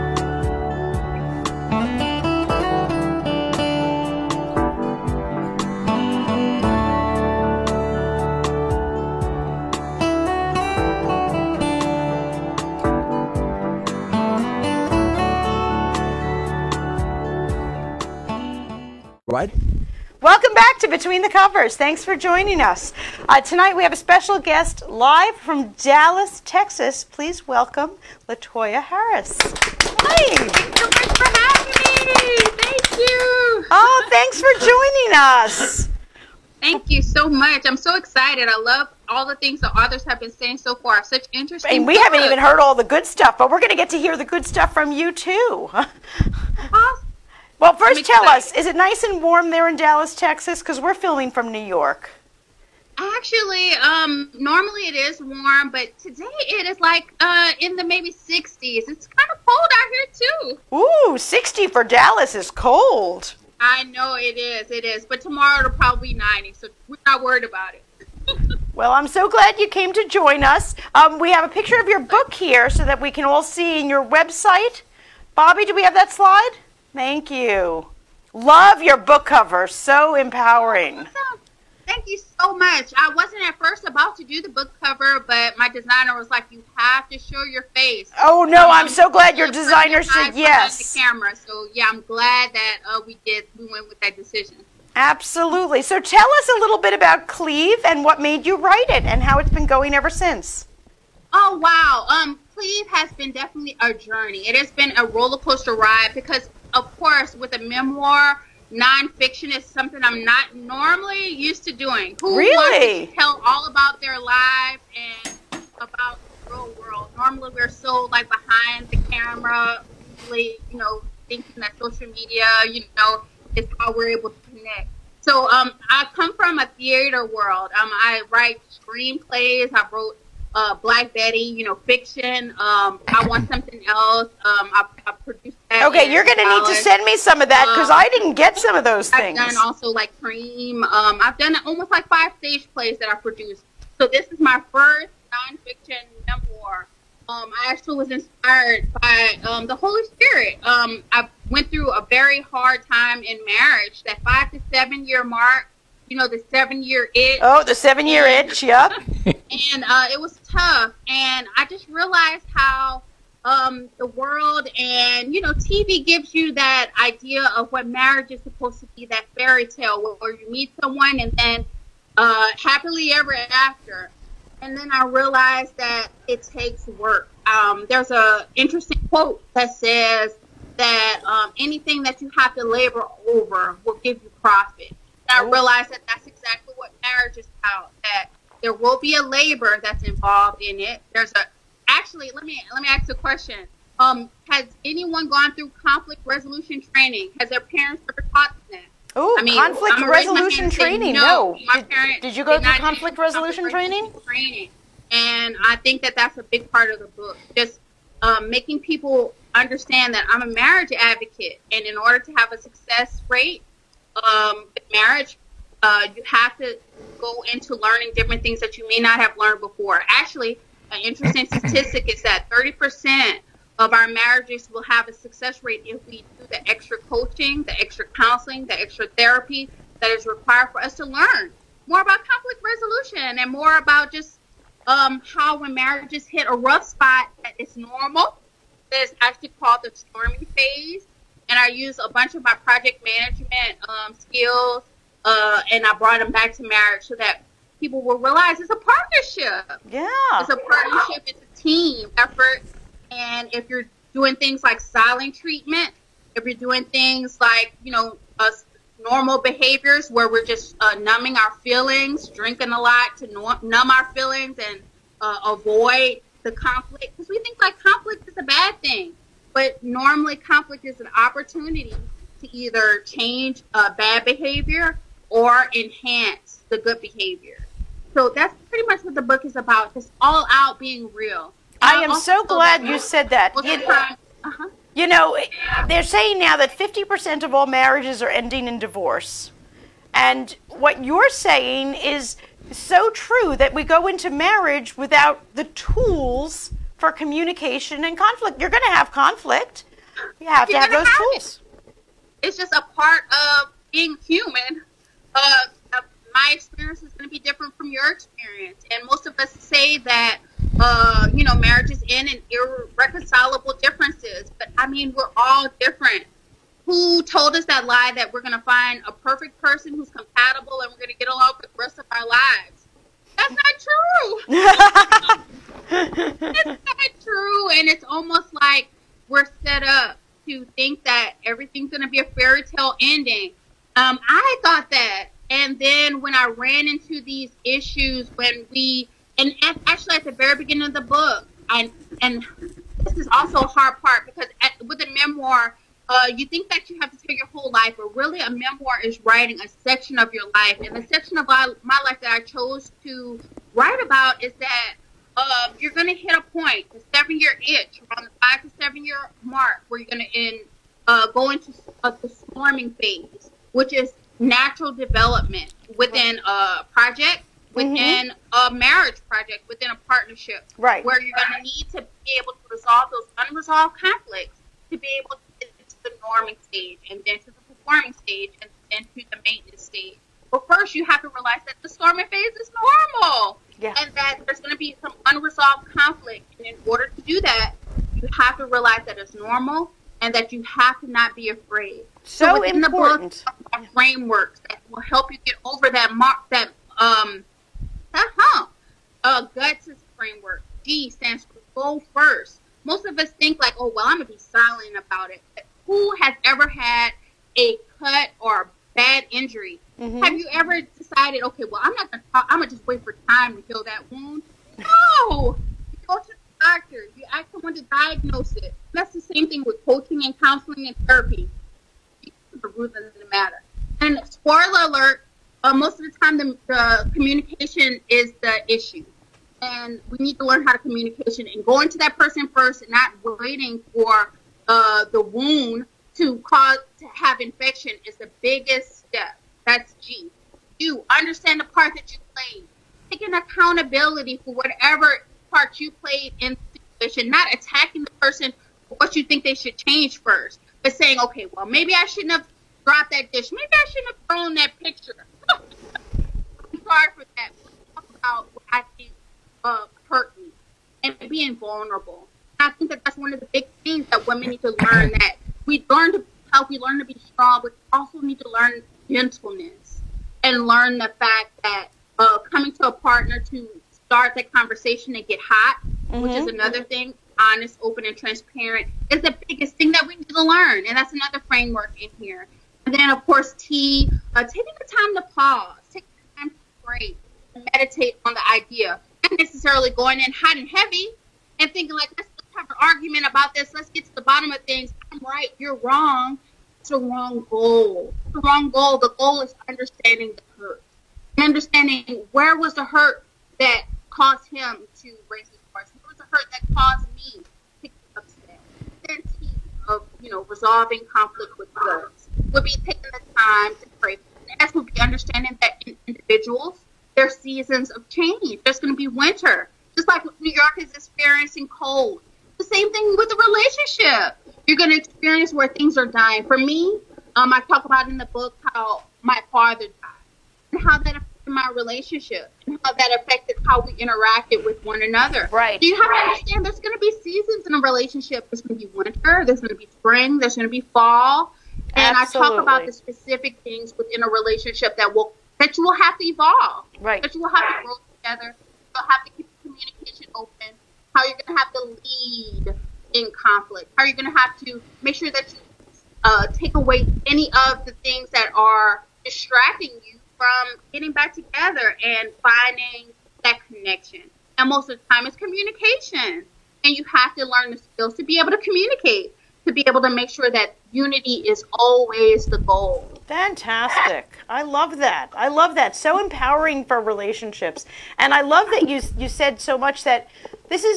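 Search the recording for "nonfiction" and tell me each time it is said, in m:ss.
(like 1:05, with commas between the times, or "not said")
1:48, 2:25.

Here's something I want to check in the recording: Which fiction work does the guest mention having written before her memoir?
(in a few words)
Black Betty.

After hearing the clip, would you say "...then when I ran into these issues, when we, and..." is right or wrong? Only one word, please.
right.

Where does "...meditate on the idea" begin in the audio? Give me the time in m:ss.
8:07.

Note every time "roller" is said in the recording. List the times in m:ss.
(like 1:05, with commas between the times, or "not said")
1:45.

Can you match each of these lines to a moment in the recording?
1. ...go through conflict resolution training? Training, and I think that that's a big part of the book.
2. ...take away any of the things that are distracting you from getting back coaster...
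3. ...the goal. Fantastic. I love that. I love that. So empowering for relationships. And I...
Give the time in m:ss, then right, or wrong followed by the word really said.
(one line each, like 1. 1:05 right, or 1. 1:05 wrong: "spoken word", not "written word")
1. 3:22 right
2. 9:16 wrong: "together", not "coaster"
3. 9:32 right.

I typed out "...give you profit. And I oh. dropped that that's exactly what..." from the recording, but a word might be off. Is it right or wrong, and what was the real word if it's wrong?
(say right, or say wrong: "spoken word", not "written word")
wrong: "realized", not "dropped".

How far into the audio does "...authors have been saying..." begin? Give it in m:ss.
0:39.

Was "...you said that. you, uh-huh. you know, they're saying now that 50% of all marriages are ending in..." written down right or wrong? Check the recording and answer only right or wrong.
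right.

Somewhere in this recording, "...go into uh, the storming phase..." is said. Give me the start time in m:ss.
6:01.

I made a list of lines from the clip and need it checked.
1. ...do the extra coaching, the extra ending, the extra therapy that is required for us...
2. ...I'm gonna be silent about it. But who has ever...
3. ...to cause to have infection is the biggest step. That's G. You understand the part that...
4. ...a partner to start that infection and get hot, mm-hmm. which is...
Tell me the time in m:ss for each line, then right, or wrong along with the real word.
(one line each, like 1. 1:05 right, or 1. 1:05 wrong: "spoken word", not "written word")
1. 3:46 wrong: "counseling", not "ending"
2. 6:44 right
3. 7:16 right
4. 7:52 wrong: "conversation", not "infection".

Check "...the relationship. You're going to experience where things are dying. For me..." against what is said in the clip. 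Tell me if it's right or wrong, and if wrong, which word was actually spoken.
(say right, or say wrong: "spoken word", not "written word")
right.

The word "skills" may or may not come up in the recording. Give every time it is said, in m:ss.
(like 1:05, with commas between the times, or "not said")
4:04, 9:27.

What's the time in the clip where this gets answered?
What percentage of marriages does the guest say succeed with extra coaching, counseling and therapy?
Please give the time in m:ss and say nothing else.
3:42.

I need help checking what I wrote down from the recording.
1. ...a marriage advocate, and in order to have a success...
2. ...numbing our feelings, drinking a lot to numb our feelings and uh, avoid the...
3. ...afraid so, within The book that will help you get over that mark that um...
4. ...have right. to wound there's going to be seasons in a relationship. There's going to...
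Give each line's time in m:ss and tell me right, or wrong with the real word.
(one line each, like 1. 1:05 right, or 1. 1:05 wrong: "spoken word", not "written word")
1. 3:30 right
2. 4:20 right
3. 6:31 right
4. 8:56 wrong: "understand", not "wound".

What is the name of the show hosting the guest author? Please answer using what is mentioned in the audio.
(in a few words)
Between the Covers.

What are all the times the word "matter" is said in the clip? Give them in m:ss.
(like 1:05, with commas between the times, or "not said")
7:03.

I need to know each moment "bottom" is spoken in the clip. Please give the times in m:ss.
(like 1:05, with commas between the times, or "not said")
8:14.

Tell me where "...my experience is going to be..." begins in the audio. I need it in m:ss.
5:06.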